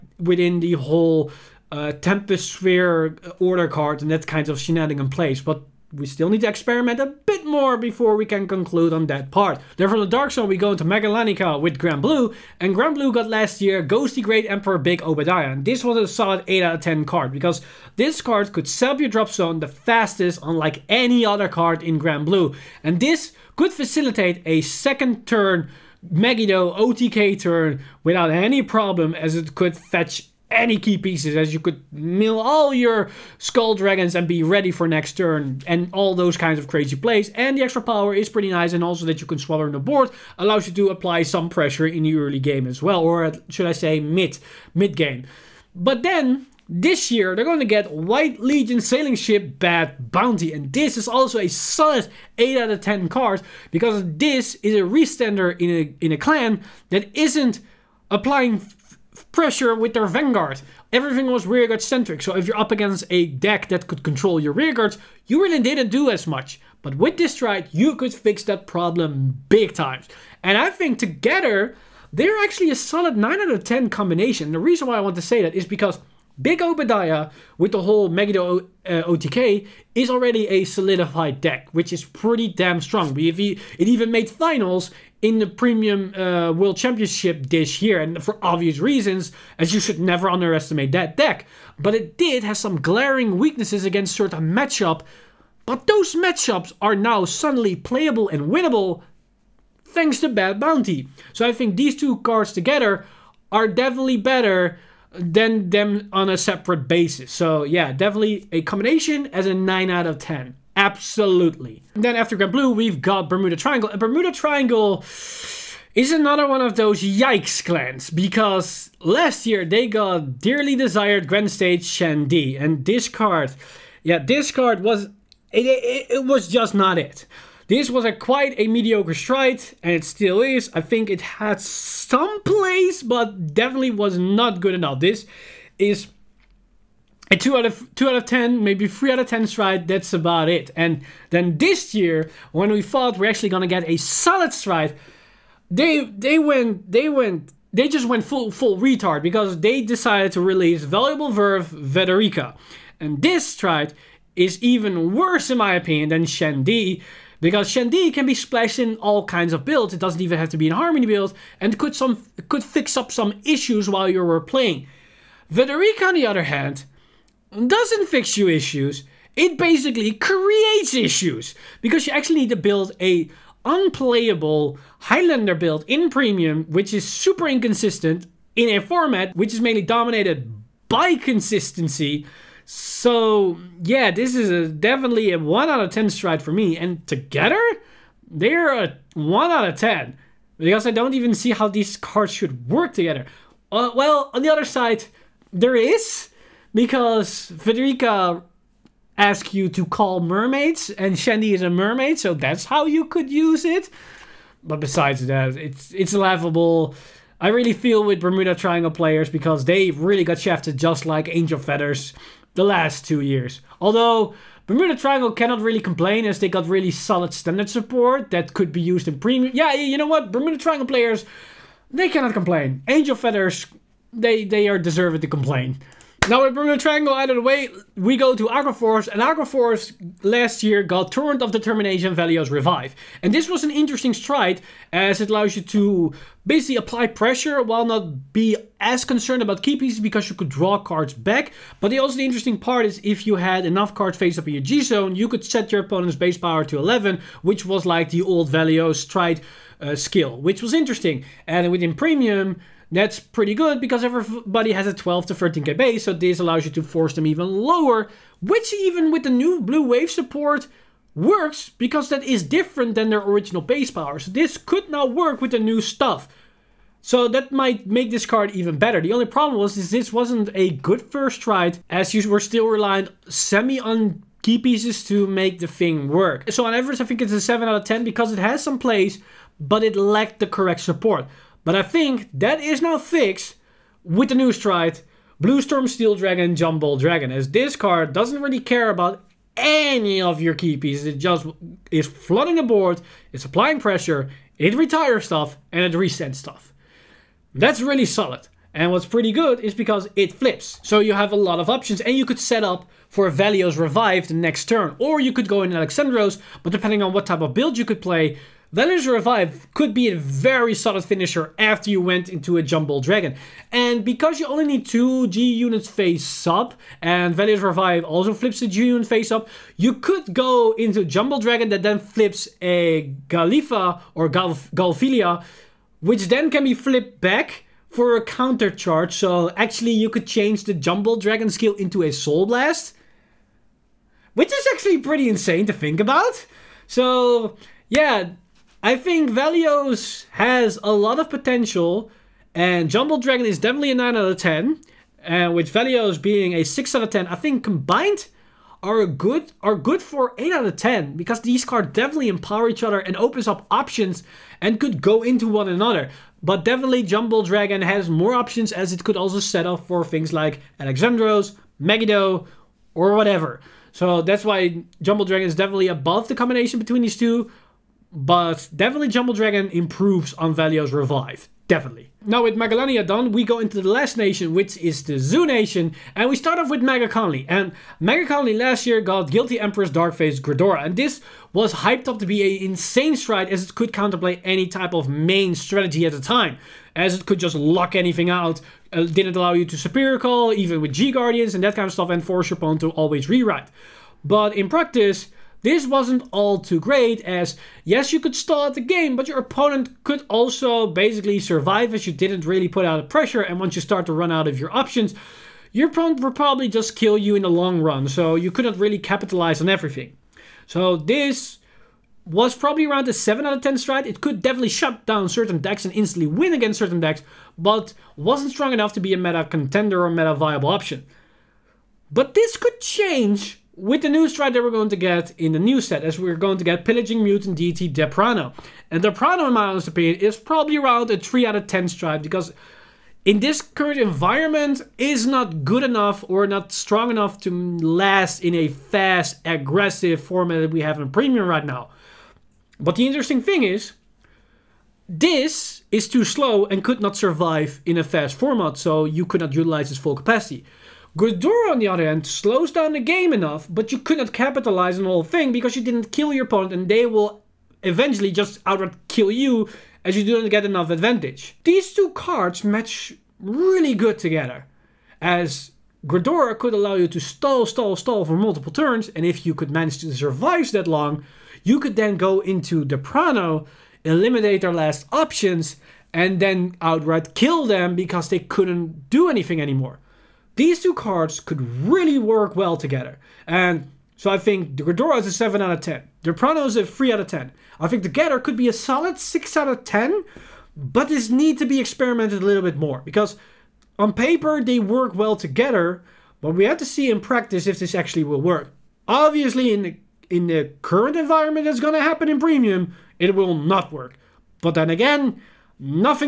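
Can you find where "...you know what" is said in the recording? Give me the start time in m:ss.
3:39.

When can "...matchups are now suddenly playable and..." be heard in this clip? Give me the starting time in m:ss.
1:36.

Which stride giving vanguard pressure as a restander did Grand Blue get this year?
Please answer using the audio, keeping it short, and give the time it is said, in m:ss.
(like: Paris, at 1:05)
White Legion Sailing Ship Bad Bounty, at 0:47.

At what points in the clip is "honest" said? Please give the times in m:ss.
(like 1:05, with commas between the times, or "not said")
7:09.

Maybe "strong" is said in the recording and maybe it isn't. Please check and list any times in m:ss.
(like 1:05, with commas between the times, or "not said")
1:22, 6:58, 7:16.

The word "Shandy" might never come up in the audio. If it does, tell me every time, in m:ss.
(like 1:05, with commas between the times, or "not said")
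2:01, 3:21.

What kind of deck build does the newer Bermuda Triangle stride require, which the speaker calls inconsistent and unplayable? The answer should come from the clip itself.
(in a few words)
Highlander.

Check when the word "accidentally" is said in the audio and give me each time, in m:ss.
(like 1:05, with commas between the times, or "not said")
not said.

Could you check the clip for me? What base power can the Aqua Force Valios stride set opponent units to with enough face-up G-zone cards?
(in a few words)
11.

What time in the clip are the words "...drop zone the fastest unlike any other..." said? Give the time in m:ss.
0:19.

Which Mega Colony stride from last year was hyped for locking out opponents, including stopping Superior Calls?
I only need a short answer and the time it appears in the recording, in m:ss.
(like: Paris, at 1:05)
Guilty Empress Darkface Gredora, at 6:19.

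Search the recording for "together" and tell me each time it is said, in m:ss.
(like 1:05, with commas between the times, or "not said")
1:10, 1:42, 3:07, 3:12, 7:44, 8:02, 8:15.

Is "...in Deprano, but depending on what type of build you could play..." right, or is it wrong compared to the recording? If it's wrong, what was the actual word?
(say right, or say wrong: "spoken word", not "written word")
wrong: "Alexandros", not "Deprano".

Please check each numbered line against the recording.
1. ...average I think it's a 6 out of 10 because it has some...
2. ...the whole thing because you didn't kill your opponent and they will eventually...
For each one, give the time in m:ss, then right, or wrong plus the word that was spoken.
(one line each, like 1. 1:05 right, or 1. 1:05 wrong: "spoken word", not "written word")
1. 4:36 wrong: "7", not "6"
2. 7:35 right.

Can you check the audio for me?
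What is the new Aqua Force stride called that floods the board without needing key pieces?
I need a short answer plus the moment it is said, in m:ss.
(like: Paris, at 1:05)
Bluestorm Steel Dragon, Jumble Dragon, at 4:45.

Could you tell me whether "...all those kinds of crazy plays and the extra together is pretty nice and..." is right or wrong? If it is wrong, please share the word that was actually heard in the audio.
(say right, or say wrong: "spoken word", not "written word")
wrong: "power", not "together".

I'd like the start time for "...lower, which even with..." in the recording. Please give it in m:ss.
4:17.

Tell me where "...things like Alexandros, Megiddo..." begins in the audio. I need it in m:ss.
6:00.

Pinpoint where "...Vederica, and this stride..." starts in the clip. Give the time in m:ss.
2:31.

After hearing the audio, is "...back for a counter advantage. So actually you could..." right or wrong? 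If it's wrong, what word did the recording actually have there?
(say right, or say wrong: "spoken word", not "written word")
wrong: "charge", not "advantage".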